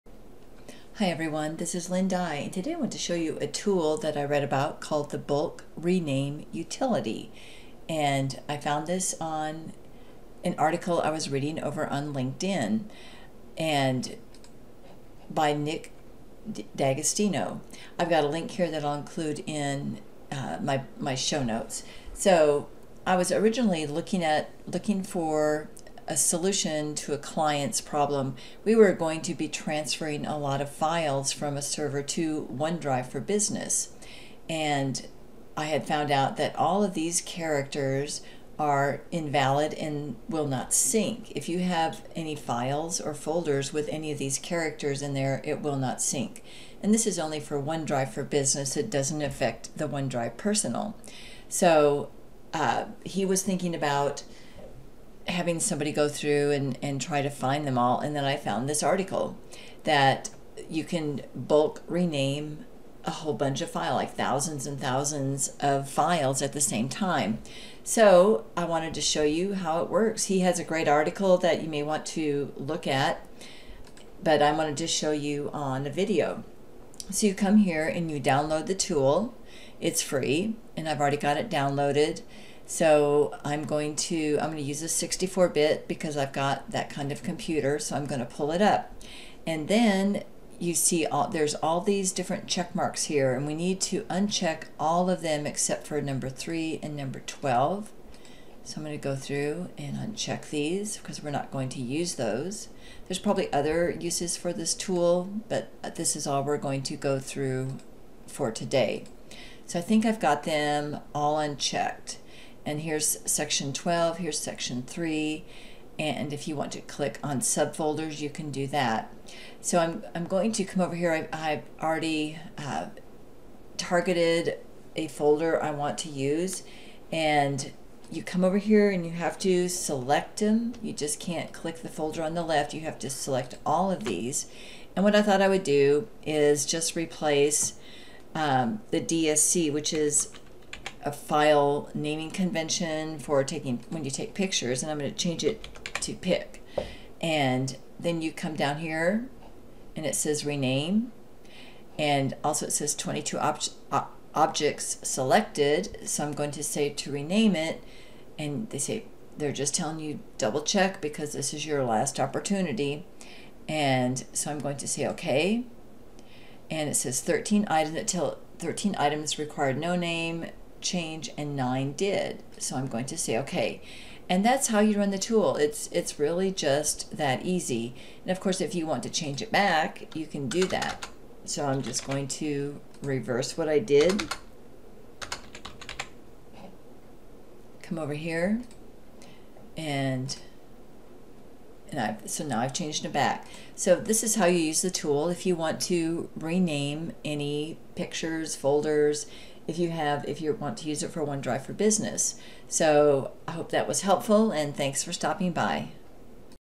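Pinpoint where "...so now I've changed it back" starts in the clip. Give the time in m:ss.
3:12.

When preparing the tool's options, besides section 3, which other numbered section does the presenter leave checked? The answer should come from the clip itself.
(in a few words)
12.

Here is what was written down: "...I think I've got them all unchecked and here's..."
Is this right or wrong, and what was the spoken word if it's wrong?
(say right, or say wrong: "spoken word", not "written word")
right.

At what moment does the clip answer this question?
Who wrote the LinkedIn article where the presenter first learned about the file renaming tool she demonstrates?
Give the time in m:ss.
0:15.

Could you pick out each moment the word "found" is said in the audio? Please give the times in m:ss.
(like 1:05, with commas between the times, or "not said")
0:08, 0:35, 0:58.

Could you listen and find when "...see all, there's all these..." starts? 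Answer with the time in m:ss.
1:30.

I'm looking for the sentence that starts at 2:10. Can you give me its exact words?
You just can't click the folder on the left.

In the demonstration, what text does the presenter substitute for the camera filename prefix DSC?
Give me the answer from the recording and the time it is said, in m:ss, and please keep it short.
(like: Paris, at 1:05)
pic, at 2:26.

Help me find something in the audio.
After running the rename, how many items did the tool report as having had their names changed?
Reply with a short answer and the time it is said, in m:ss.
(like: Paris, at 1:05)
9, at 2:51.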